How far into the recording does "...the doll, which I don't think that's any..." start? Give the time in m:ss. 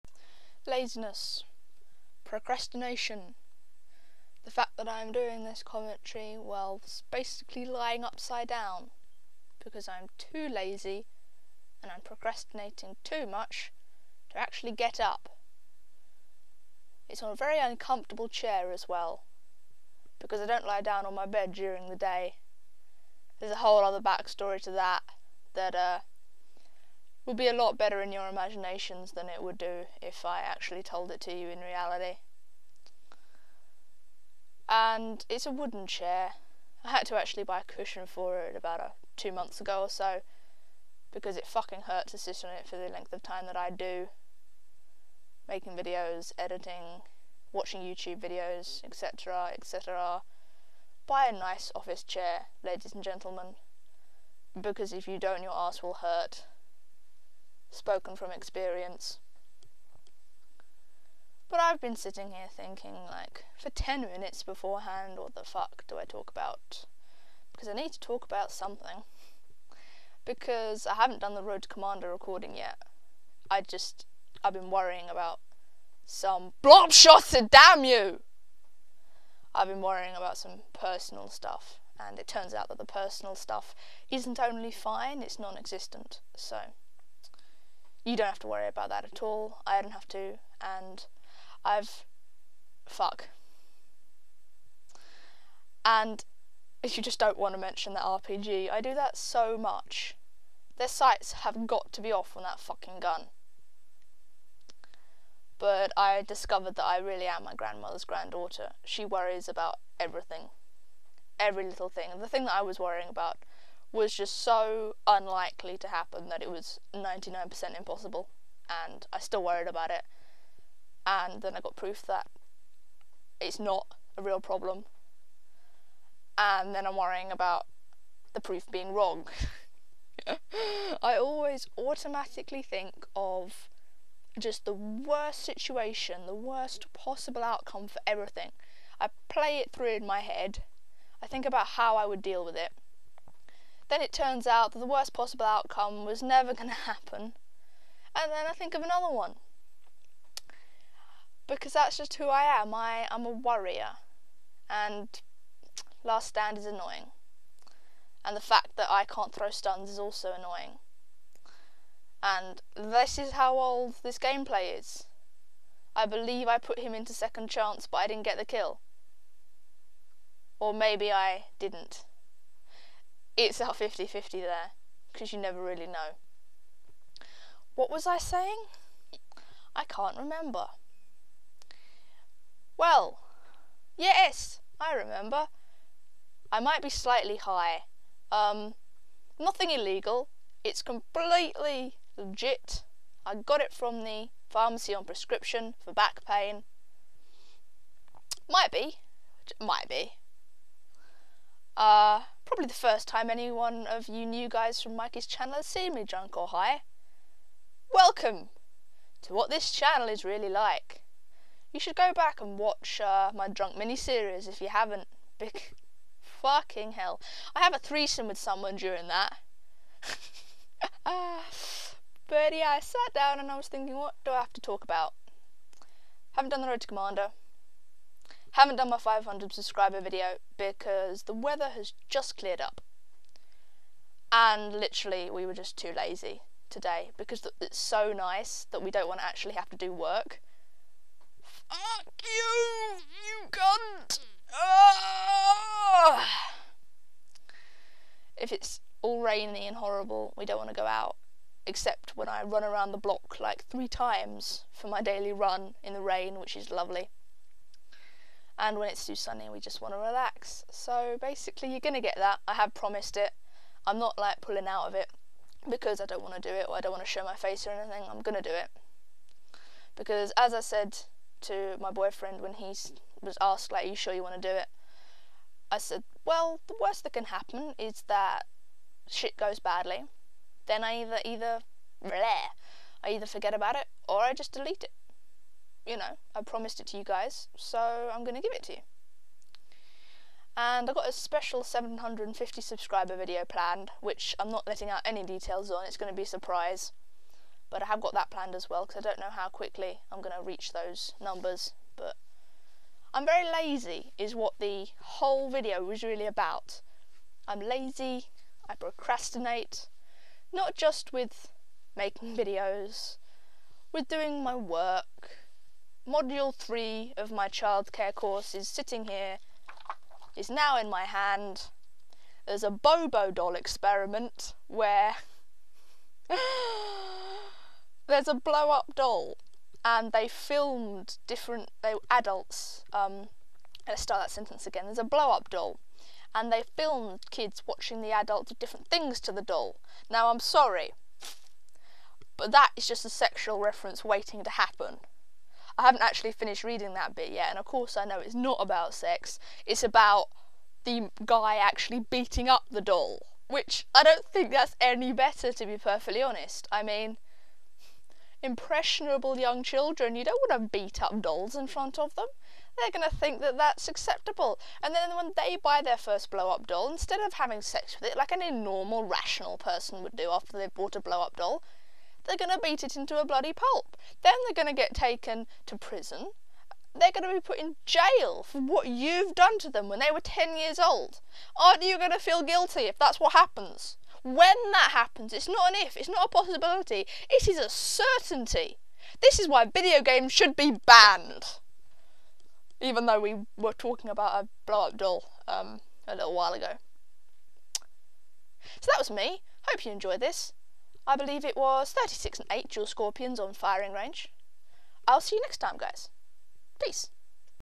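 5:52.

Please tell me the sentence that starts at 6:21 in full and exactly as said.
Aren't you going to feel guilty if that's what happens?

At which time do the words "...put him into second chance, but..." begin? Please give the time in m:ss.
2:46.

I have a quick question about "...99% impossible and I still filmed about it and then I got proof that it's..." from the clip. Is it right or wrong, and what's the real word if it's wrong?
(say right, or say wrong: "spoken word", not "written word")
wrong: "worried", not "filmed".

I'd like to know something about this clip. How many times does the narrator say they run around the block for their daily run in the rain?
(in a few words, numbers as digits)
3.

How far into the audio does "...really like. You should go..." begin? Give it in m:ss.
3:30.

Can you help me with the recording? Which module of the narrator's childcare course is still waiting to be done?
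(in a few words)
module 3.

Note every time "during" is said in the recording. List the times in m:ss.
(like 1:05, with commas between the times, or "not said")
0:21, 3:38.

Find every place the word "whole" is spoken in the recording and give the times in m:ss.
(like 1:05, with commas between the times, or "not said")
0:23, 5:04.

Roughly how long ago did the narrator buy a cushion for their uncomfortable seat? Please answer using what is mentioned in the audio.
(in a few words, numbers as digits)
two months.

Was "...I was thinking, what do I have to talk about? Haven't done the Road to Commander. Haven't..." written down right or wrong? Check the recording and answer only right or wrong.
right.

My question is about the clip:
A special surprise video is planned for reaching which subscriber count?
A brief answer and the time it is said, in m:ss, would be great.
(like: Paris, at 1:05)
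750, at 4:51.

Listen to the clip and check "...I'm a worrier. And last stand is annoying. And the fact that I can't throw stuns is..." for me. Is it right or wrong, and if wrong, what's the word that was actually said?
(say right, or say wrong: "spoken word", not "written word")
right.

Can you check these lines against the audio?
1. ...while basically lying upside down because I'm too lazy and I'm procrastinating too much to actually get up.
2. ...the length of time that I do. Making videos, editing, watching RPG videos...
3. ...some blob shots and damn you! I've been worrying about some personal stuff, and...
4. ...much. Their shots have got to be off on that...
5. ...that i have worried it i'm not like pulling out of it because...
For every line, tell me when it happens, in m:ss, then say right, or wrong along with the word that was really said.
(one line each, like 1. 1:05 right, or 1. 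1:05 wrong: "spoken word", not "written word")
1. 0:06 right
2. 0:42 wrong: "YouTube", not "RPG"
3. 1:16 right
4. 1:39 wrong: "sights", not "shots"
5. 4:22 wrong: "promised", not "worried".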